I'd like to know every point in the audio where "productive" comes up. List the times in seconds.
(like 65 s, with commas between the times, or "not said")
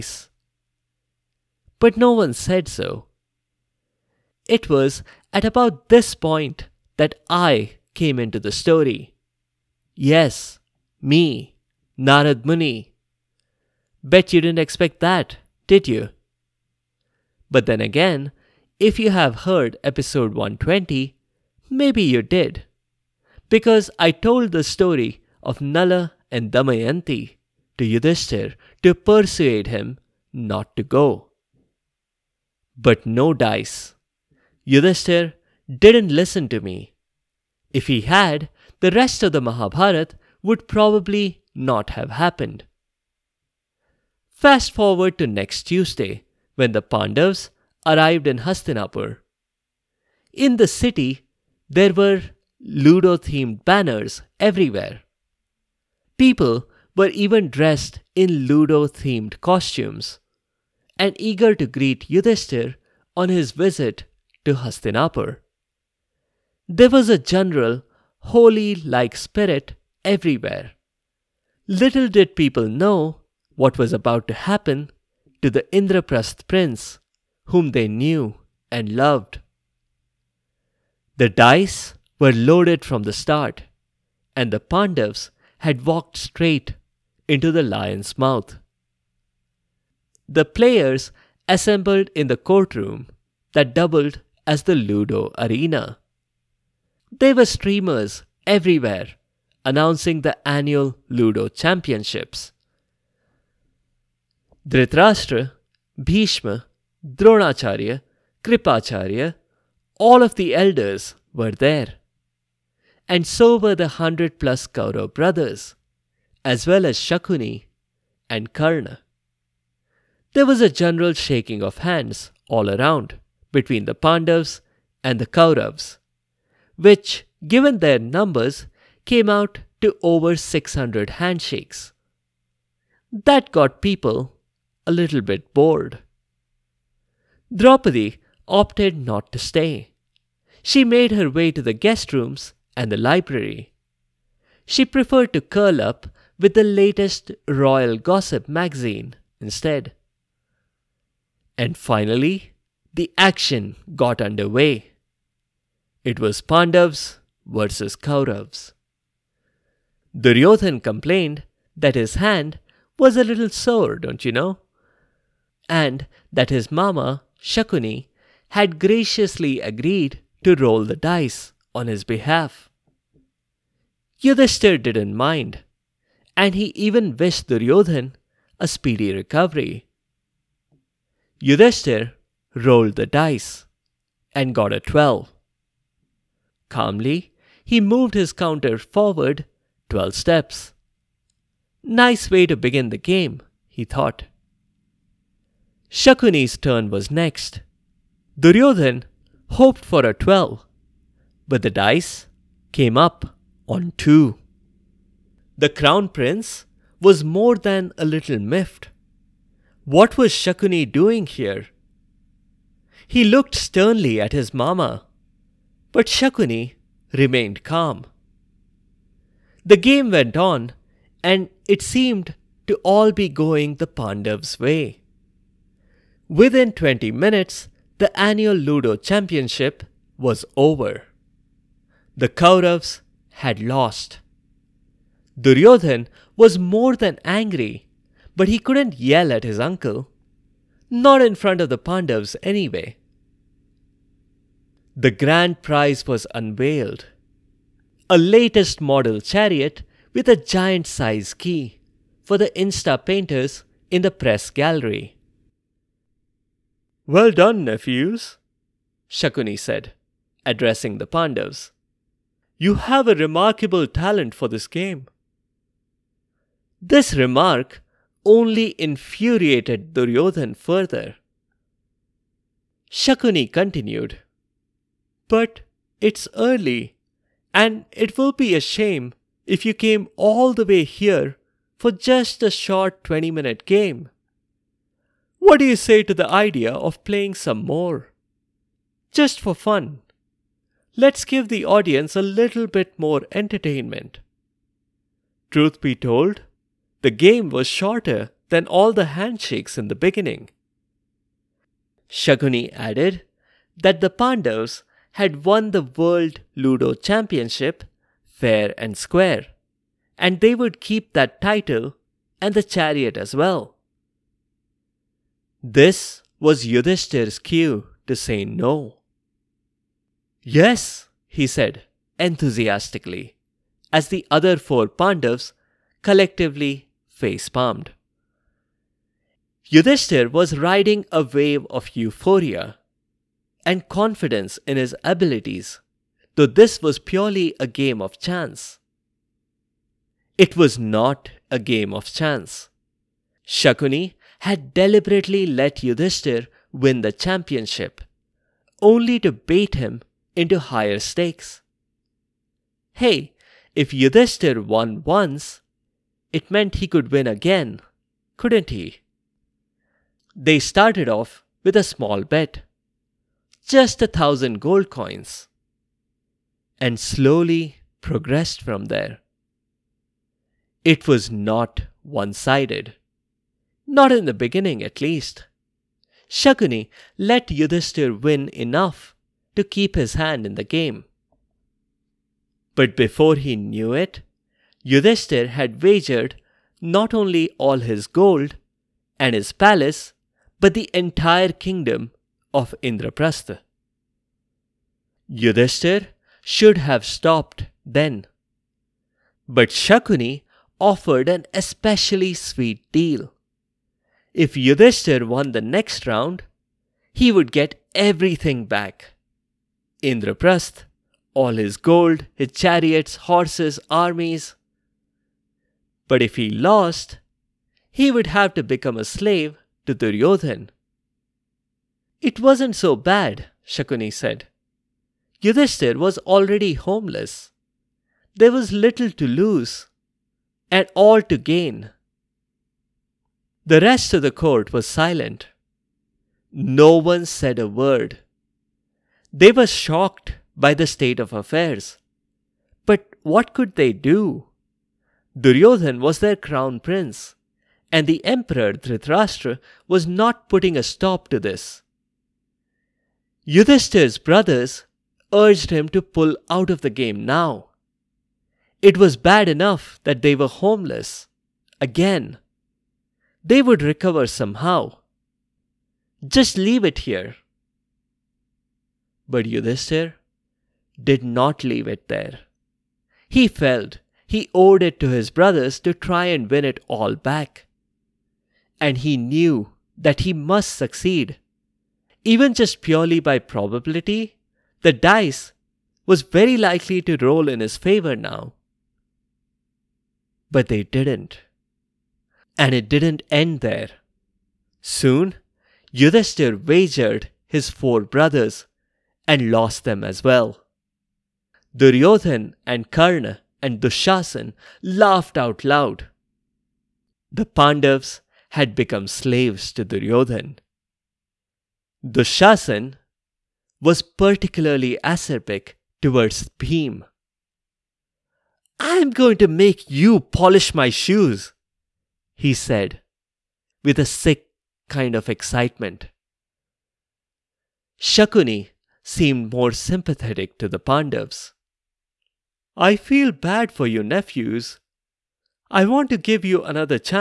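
not said.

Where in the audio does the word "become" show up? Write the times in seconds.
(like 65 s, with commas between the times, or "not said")
418 s, 508 s.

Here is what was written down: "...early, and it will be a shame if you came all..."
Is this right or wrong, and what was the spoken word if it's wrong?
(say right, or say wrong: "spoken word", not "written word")
right.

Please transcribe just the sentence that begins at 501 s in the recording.
Duryodhan and Karna and Dushasan laughed out loud.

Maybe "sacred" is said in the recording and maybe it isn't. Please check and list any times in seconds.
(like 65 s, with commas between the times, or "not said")
not said.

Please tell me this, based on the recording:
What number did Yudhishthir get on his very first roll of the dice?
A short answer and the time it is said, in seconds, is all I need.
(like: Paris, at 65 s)
12, at 184 s.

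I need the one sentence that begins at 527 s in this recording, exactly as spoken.
Shakuni seemed more sympathetic to the Pandavs.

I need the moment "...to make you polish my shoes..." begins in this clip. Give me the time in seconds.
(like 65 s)
519 s.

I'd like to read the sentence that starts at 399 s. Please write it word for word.
But Shakuni offered an especially sweet deal.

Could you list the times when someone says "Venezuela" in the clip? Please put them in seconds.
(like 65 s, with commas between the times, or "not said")
not said.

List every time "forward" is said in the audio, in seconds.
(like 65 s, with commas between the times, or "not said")
44 s, 188 s.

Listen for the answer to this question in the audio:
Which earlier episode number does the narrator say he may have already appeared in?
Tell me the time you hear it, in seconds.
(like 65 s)
19 s.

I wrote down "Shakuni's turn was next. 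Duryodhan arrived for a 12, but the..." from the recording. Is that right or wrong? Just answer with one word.
wrong.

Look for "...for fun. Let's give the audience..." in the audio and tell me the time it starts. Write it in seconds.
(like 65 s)
289 s.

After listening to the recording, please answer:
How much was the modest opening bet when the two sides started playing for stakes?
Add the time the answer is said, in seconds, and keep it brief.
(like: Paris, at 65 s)
1000 gold coins, at 364 s.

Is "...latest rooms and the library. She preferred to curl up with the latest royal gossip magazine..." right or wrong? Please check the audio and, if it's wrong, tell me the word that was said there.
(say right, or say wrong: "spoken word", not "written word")
wrong: "guest", not "latest".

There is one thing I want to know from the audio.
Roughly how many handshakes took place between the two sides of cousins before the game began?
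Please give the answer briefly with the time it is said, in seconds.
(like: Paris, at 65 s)
Over 600, at 130 s.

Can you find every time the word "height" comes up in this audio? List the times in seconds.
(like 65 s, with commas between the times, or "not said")
not said.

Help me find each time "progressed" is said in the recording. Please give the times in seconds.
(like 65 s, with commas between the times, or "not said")
368 s.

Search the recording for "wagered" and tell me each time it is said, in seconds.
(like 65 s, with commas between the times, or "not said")
385 s, 496 s.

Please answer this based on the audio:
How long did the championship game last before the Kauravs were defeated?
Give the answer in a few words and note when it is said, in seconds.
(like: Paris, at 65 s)
20 minutes, at 226 s.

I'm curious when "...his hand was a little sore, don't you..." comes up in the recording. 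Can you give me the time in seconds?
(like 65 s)
161 s.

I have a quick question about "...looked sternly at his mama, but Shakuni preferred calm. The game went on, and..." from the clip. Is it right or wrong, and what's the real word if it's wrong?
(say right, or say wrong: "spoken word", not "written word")
wrong: "remained", not "preferred".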